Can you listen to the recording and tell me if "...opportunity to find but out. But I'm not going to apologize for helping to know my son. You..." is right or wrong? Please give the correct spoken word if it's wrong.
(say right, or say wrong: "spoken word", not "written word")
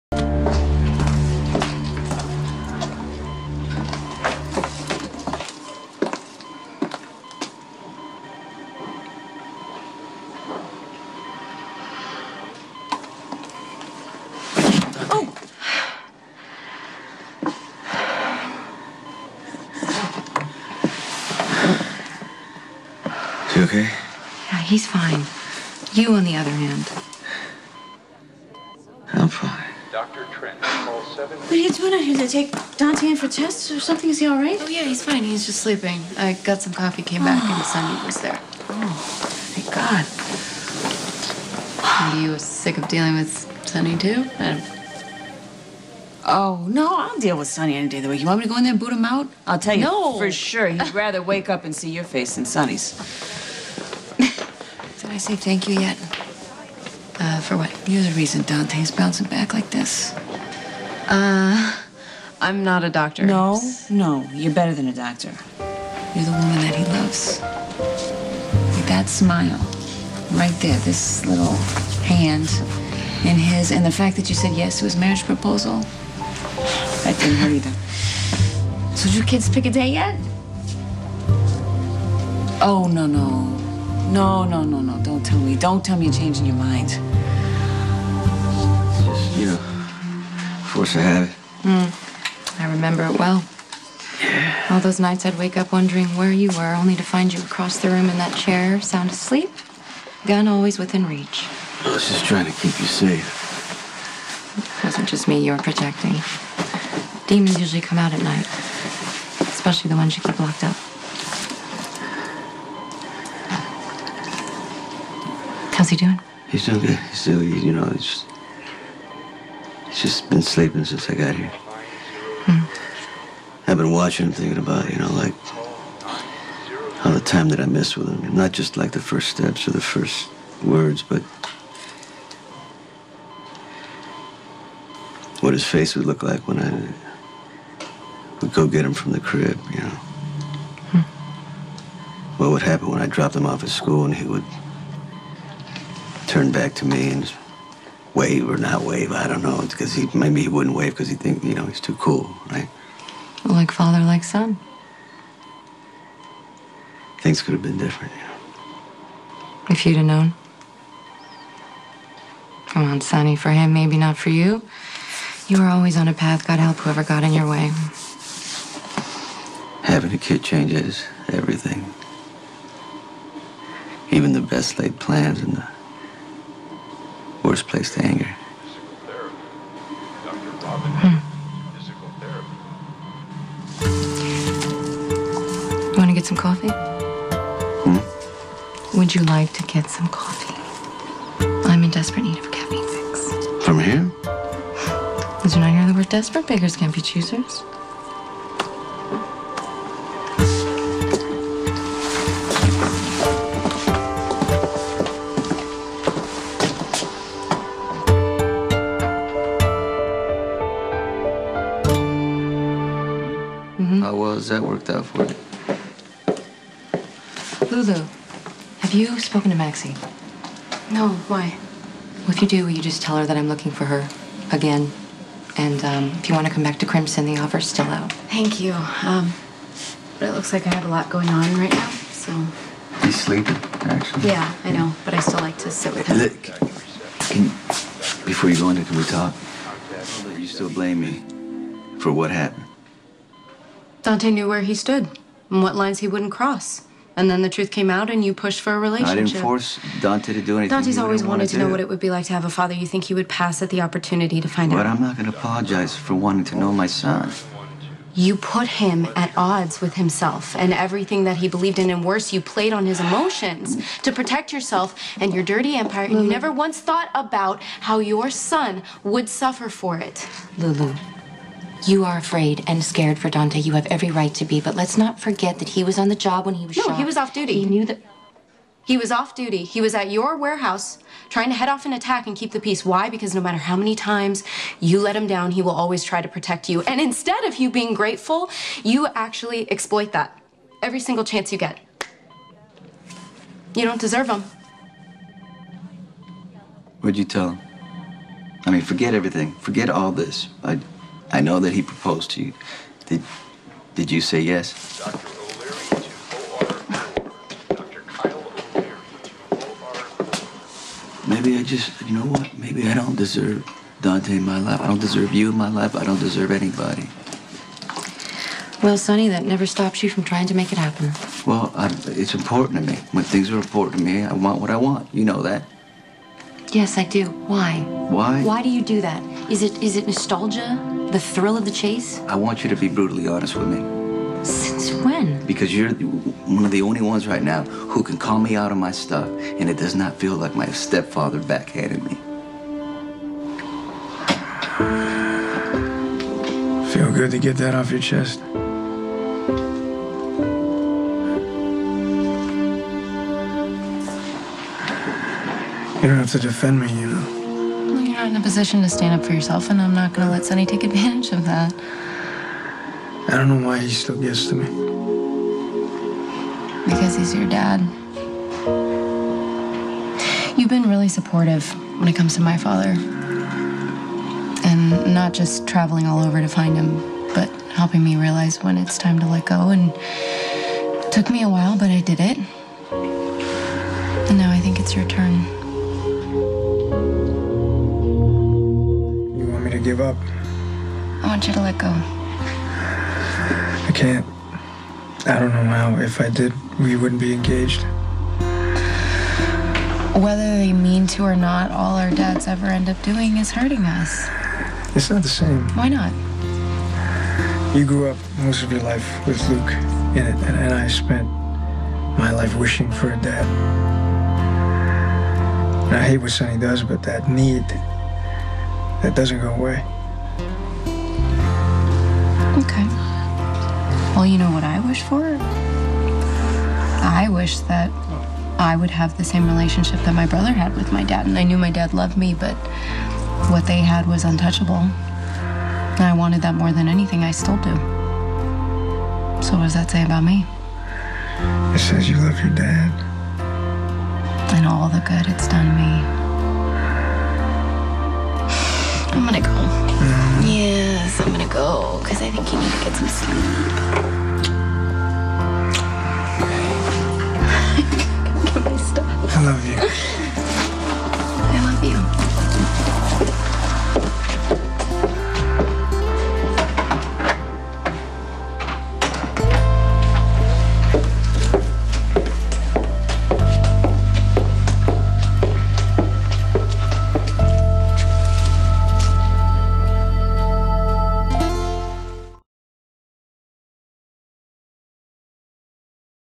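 wrong: "wanting", not "helping".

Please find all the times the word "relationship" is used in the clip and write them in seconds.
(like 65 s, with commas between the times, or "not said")
248 s, 429 s.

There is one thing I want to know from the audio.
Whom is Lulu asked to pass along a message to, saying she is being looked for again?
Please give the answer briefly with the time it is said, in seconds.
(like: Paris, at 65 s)
Maxie, at 219 s.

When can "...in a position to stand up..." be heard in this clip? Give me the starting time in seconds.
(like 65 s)
358 s.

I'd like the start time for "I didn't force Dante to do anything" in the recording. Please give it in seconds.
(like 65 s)
249 s.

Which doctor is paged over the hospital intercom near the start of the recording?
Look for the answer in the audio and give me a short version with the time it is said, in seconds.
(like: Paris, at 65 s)
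Dr. Trent, at 29 s.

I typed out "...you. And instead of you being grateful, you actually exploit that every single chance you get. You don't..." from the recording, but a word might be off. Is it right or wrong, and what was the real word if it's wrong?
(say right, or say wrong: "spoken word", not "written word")
right.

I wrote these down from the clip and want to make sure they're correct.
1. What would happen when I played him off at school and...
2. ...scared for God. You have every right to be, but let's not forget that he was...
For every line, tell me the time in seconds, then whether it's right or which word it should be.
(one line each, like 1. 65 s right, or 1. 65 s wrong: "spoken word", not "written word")
1. 142 s wrong: "dropped", not "played"
2. 272 s wrong: "Dante", not "God".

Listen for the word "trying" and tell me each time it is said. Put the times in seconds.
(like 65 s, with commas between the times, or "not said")
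102 s, 281 s, 320 s.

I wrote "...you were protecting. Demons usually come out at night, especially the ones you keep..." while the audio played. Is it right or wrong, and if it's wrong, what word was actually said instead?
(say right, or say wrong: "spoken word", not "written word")
right.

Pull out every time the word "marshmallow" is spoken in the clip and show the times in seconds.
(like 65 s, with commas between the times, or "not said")
not said.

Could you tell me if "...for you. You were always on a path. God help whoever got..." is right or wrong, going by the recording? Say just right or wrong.
right.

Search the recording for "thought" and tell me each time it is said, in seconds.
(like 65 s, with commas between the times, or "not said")
266 s.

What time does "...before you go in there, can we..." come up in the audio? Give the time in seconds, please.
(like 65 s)
238 s.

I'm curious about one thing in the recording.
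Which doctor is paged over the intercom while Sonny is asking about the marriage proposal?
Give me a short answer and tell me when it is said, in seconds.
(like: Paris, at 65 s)
Dr. O'Leary, at 304 s.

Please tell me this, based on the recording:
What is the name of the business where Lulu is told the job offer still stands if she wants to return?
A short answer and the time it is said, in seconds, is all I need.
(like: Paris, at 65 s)
Crimson, at 226 s.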